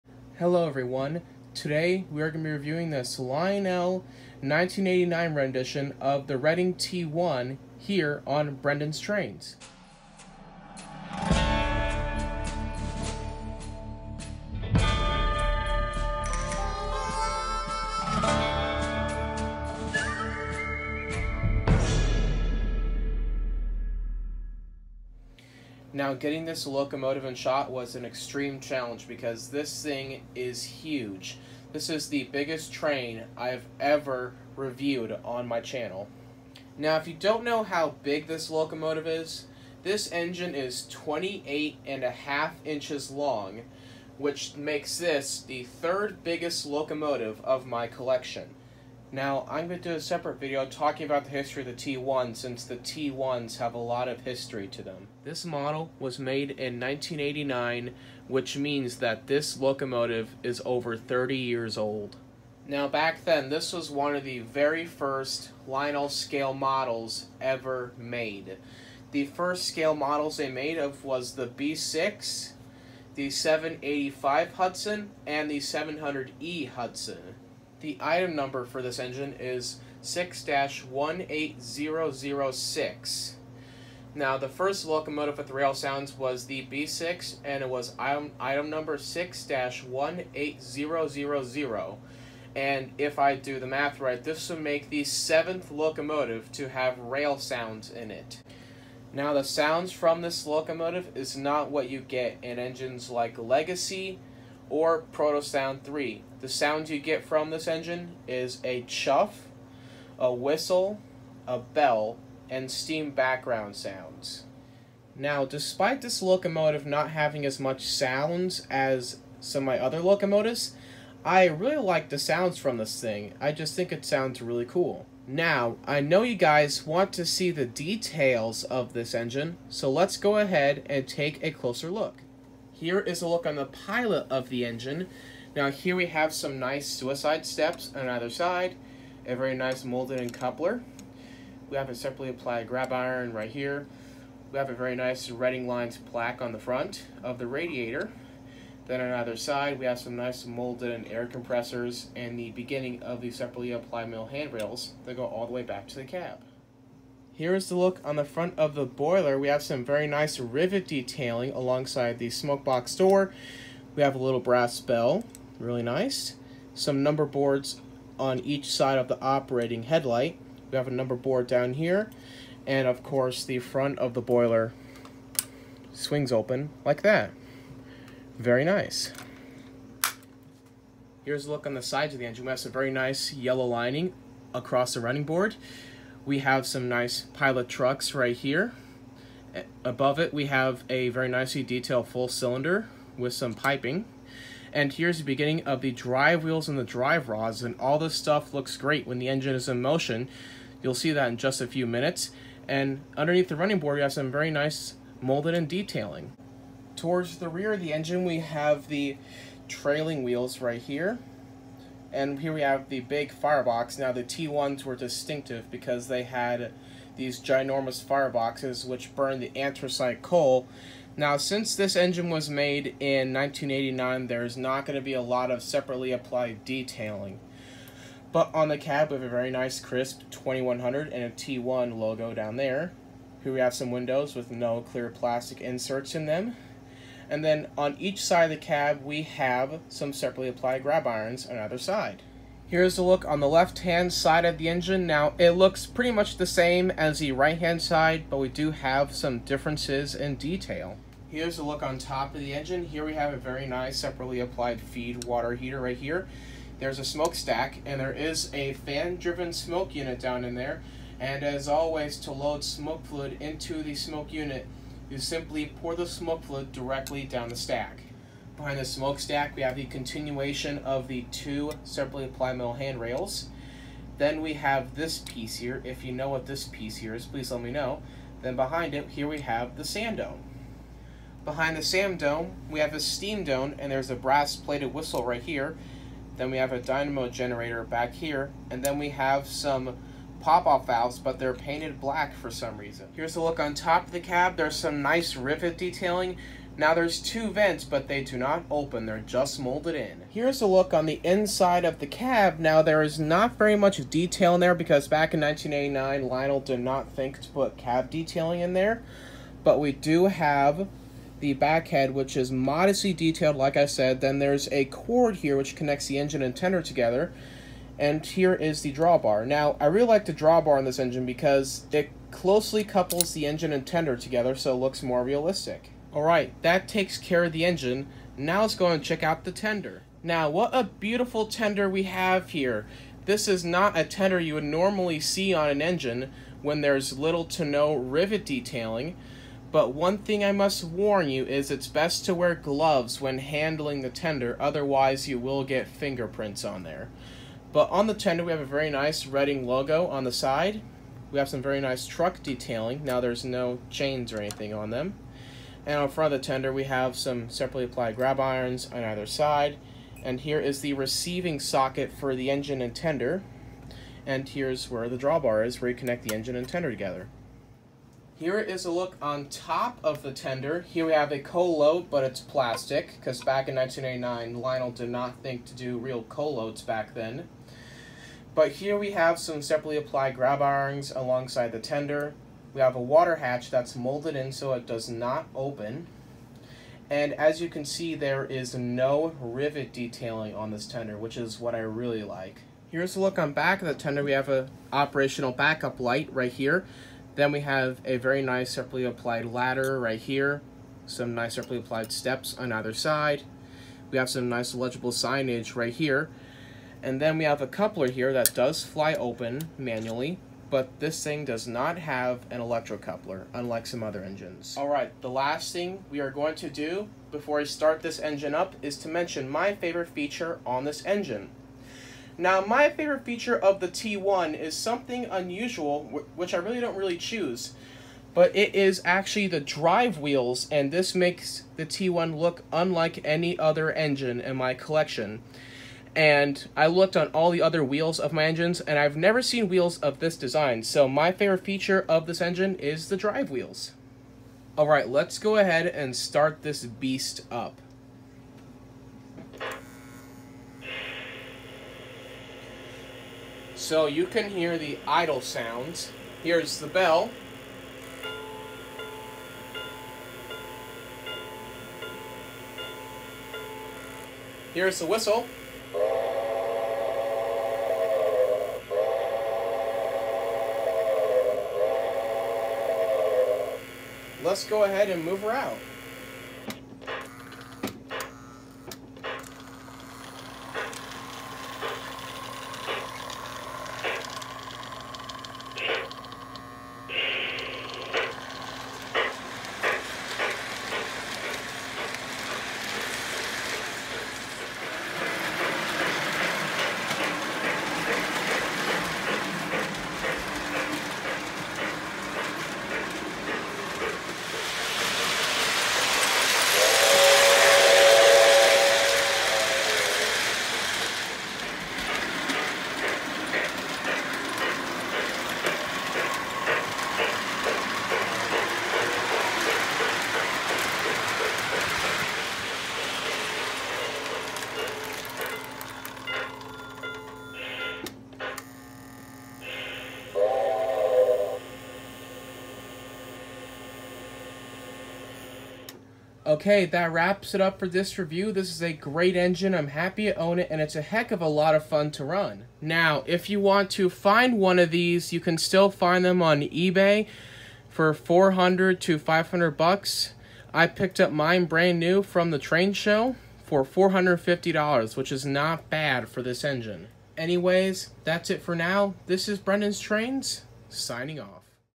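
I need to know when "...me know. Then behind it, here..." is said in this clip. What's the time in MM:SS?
04:37.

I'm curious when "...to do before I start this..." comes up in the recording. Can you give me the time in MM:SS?
06:56.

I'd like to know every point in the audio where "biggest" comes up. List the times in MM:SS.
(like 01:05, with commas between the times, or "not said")
00:32, 00:46.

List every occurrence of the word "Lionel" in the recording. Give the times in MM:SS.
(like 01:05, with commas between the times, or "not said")
00:03, 01:05, 05:06, 06:14.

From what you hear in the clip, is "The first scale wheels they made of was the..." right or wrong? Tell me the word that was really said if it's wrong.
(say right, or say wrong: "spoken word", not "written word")
wrong: "models", not "wheels".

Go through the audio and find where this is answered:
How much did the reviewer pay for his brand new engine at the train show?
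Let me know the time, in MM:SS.
09:13.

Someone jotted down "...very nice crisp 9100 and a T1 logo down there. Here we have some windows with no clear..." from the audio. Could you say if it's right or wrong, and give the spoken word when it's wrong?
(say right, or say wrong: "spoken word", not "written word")
wrong: "2100", not "9100".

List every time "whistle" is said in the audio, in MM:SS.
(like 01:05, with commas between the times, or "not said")
01:50, 04:44, 07:45.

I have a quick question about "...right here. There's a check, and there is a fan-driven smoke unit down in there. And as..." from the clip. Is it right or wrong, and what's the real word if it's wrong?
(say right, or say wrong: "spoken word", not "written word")
wrong: "smokestack", not "check".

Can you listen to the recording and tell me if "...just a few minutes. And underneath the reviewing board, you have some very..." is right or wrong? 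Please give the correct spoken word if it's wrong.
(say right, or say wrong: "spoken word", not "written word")
wrong: "running", not "reviewing".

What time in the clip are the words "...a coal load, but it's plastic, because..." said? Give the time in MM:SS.
06:11.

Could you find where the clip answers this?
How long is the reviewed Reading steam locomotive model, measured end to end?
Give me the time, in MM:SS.
00:40.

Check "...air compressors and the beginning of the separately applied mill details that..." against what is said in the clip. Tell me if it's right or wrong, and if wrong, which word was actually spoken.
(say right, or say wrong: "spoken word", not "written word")
wrong: "handrails", not "details".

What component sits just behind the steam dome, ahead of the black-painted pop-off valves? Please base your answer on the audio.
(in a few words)
dynamo generator.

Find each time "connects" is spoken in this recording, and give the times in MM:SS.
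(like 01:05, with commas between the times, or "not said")
05:15, 06:05.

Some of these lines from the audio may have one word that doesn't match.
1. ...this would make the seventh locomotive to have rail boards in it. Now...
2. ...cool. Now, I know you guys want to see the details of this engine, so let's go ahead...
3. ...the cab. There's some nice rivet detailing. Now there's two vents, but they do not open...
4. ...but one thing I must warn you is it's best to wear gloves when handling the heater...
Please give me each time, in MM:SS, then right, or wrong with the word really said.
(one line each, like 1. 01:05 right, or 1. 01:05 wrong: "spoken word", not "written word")
1. 01:34 wrong: "sounds", not "boards"
2. 02:04 right
3. 04:54 right
4. 05:39 wrong: "tender", not "heater".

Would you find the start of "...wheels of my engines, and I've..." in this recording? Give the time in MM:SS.
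07:17.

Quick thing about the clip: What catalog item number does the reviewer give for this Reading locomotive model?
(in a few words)
6-18006.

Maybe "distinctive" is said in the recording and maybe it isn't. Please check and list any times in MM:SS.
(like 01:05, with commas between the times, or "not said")
03:34.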